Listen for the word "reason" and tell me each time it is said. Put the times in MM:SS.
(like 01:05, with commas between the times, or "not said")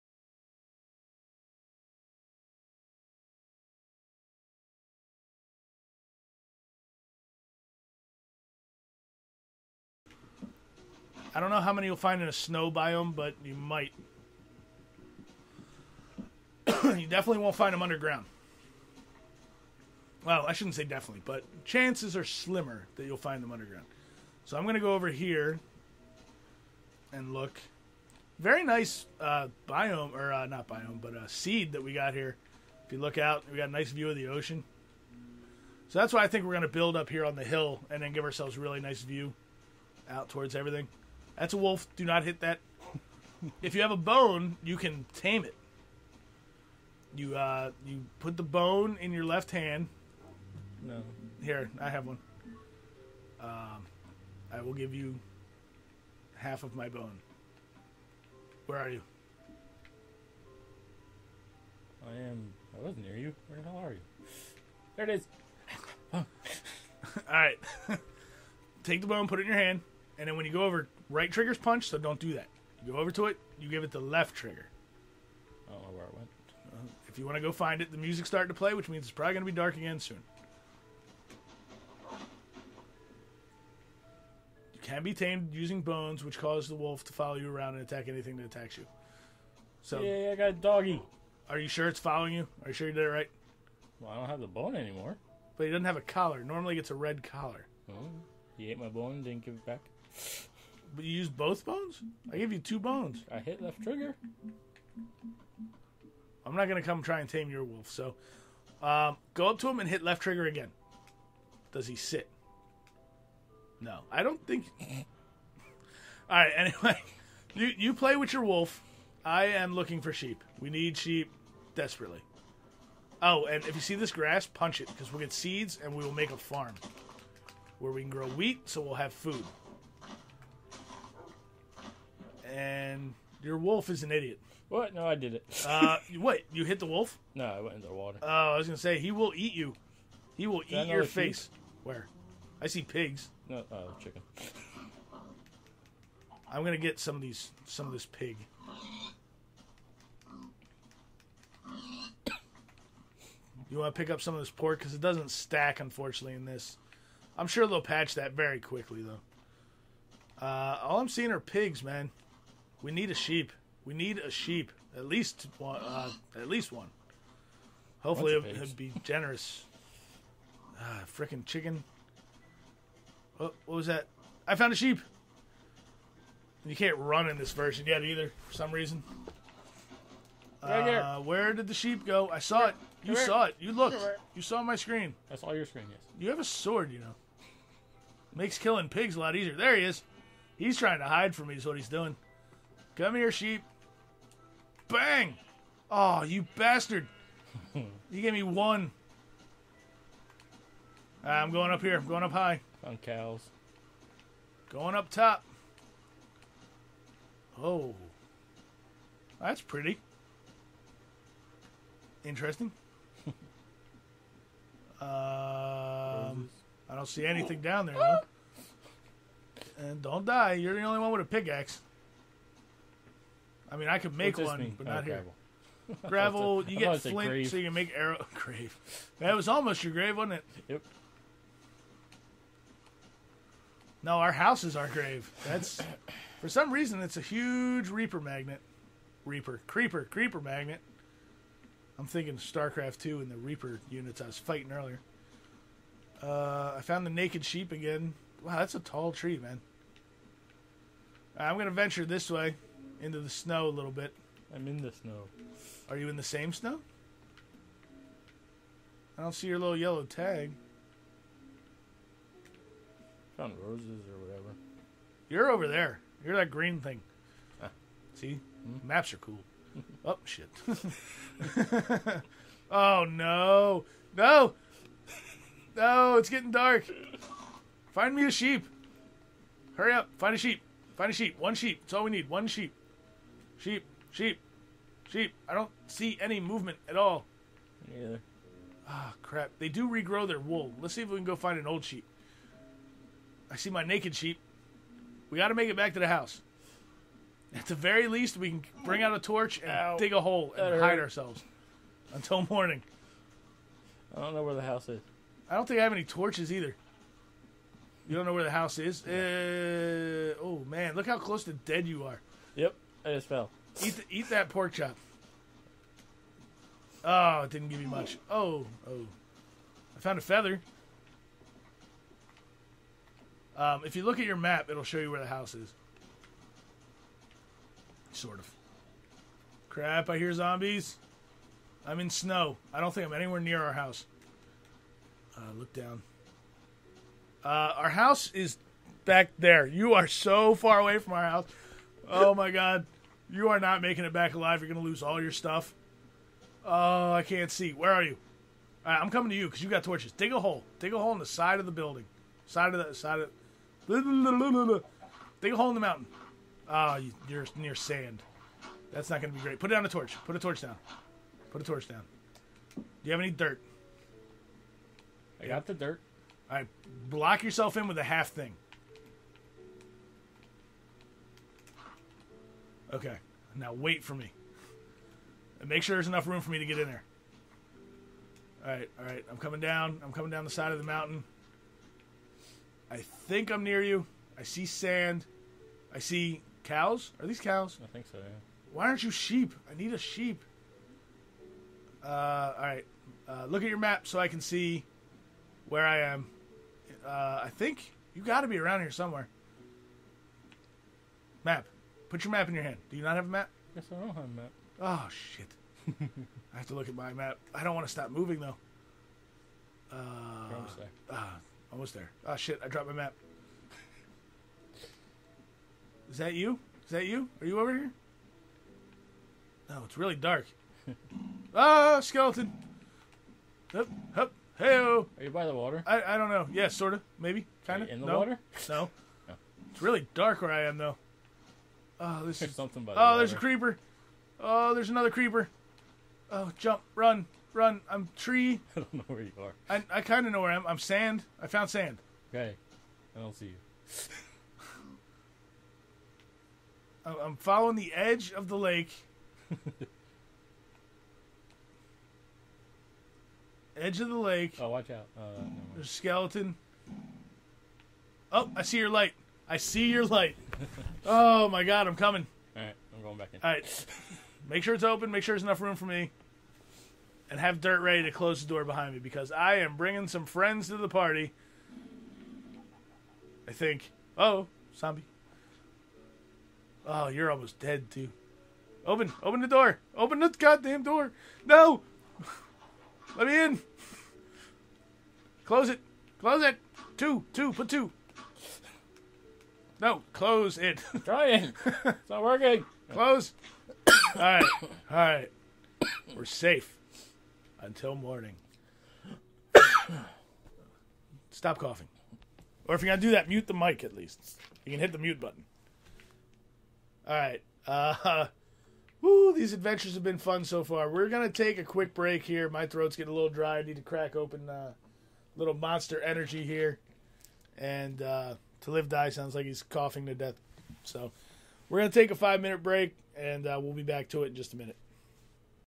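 02:58, 03:56.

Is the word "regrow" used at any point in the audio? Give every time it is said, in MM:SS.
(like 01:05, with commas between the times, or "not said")
04:49.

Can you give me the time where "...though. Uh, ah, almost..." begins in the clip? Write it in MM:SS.
06:48.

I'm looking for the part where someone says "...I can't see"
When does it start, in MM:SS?
05:47.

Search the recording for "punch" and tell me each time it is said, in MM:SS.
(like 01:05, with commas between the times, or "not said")
01:11, 02:04.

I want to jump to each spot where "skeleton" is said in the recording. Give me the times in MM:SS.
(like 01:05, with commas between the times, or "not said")
07:02, 07:35.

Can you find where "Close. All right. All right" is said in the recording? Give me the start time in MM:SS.
08:12.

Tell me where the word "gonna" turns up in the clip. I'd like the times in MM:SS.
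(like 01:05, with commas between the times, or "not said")
01:46, 02:18, 02:26, 04:11.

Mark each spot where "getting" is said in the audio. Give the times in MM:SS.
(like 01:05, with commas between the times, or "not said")
04:36, 08:32.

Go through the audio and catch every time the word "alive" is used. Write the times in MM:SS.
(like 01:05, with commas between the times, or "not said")
05:44.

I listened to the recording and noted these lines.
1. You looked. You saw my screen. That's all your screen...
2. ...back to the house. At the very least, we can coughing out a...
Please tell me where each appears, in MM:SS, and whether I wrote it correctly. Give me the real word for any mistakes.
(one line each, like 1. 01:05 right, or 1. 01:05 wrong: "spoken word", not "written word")
1. 03:03 right
2. 04:55 wrong: "bring", not "coughing".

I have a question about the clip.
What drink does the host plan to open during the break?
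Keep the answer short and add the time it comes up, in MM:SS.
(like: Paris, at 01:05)
Monster Energy, at 08:35.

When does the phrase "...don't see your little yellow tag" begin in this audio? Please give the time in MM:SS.
04:19.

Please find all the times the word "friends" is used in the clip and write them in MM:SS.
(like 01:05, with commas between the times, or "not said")
07:50.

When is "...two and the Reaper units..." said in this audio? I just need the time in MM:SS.
04:02.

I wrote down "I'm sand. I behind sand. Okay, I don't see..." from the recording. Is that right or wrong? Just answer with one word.
wrong.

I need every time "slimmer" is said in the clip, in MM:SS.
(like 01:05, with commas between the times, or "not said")
00:22.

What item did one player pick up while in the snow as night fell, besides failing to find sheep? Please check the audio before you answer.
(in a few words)
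A feather.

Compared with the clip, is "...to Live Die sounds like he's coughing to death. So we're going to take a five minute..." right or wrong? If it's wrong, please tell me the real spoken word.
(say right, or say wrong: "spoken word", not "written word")
right.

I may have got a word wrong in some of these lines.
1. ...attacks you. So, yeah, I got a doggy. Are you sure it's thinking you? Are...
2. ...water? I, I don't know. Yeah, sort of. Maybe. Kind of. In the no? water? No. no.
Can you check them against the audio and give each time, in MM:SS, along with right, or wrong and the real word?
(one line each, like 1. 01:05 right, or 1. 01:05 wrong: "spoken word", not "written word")
1. 01:28 wrong: "following", not "thinking"
2. 07:05 right.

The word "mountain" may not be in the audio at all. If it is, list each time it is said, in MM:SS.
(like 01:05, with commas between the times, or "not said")
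05:55, 06:20.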